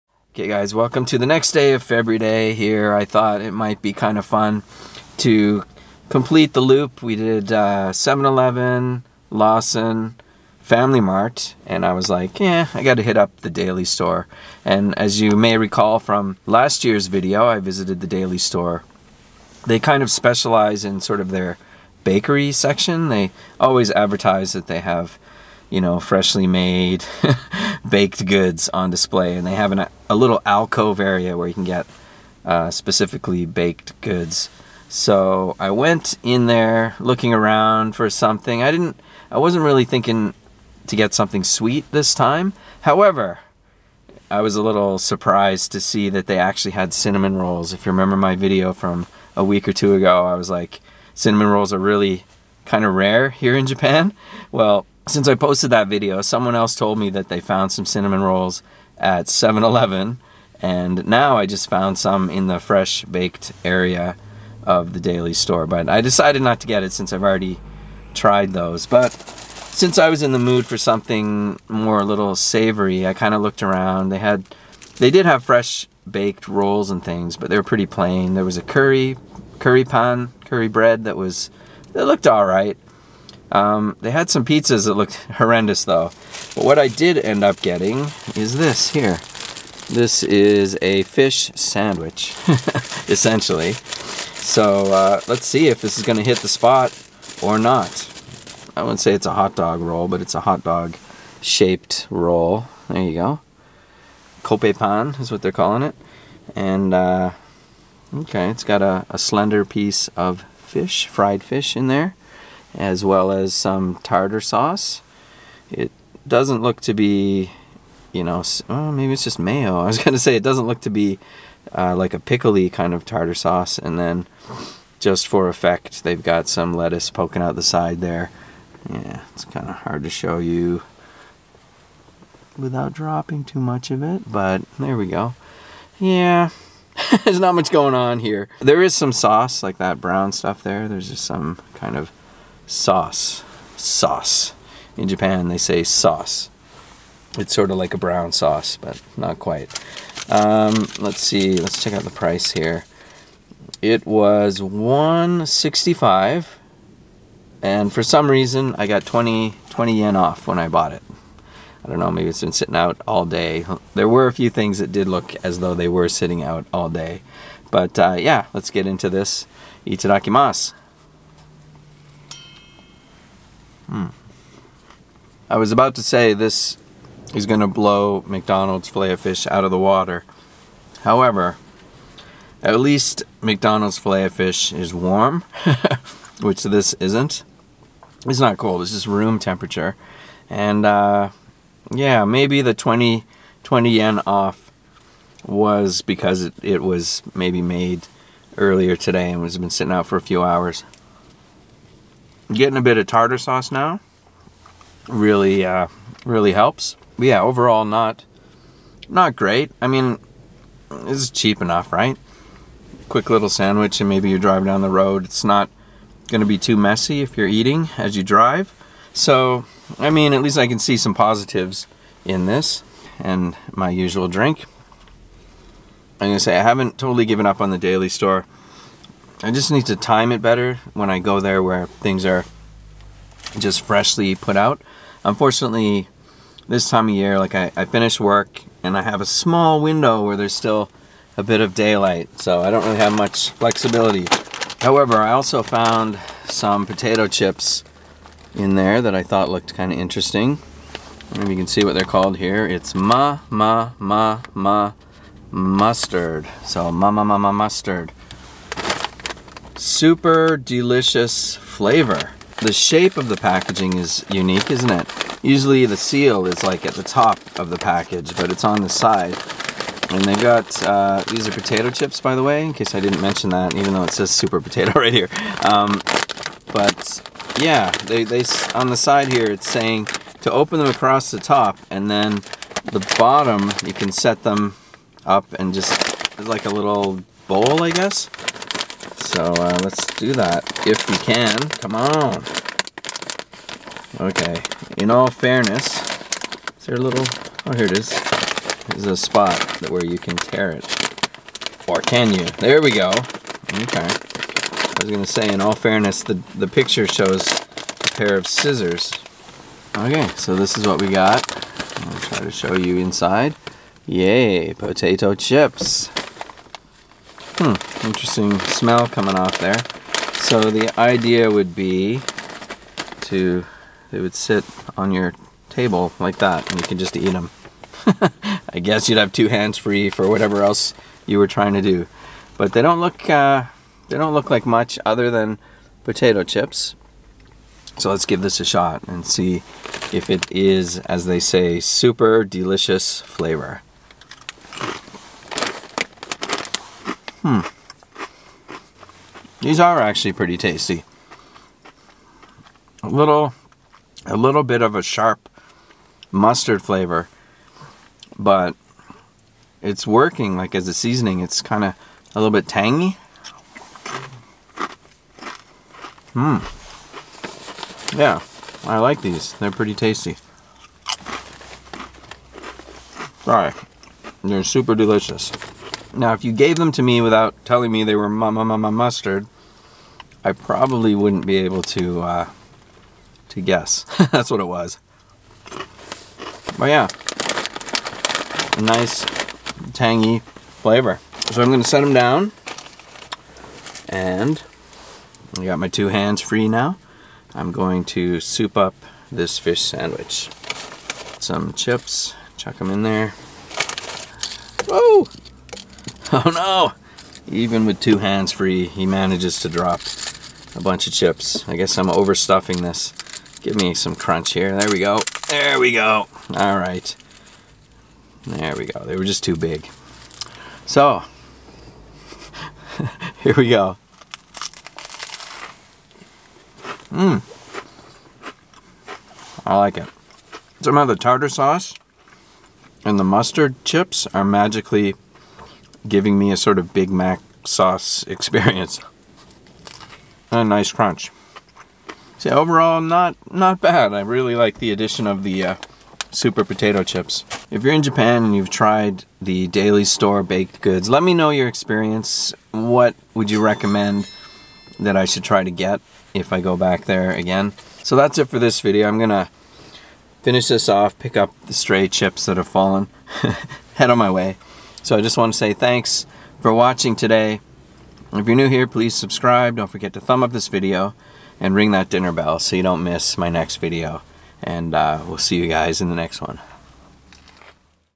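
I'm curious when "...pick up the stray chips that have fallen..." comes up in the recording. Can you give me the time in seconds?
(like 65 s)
461 s.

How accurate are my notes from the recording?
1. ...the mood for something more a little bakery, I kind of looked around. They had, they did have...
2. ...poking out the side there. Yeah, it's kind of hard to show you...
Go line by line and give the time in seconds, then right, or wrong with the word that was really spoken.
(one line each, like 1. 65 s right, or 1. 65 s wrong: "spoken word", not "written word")
1. 70 s wrong: "savory", not "bakery"
2. 127 s right.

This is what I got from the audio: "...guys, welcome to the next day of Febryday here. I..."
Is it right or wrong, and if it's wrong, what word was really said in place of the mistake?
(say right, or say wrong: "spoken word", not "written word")
right.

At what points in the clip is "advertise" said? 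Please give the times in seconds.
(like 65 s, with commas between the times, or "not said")
23 s.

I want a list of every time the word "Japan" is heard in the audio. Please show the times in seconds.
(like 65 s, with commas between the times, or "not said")
53 s, 145 s, 448 s.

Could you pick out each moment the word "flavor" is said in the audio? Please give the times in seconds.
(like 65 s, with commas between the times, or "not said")
261 s, 343 s, 356 s, 390 s.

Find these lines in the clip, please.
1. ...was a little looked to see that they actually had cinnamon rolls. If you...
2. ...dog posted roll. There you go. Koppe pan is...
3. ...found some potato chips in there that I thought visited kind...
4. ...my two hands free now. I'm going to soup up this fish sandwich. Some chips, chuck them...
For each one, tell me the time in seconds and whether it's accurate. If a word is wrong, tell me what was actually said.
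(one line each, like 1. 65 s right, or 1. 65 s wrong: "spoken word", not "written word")
1. 44 s wrong: "surprised", not "looked"
2. 100 s wrong: "shaped", not "posted"
3. 245 s wrong: "looked", not "visited"
4. 395 s right.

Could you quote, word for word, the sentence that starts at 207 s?
But yeah, overall not not great.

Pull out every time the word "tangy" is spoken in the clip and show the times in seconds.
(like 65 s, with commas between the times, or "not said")
362 s, 389 s.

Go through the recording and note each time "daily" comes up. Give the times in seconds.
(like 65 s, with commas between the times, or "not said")
13 s, 18 s, 64 s, 227 s, 449 s.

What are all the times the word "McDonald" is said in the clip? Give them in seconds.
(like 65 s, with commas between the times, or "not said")
178 s, 183 s.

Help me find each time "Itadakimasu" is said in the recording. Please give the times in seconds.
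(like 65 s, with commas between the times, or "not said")
169 s.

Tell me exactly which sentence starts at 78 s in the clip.
There was a curry, curry pan, curry bread that was, it looked all right.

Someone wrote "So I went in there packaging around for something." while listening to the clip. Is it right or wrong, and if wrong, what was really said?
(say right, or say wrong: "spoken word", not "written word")
wrong: "looking", not "packaging".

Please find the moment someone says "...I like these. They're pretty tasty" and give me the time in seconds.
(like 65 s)
368 s.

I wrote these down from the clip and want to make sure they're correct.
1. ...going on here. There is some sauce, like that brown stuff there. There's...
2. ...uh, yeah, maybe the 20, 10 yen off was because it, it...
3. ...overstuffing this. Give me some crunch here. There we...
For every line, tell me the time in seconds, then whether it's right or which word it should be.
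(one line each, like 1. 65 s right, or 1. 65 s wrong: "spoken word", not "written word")
1. 137 s right
2. 190 s wrong: "20", not "10"
3. 412 s right.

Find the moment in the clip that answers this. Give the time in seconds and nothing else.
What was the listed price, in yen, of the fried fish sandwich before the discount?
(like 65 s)
154 s.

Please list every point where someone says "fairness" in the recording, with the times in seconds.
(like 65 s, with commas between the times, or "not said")
295 s, 305 s.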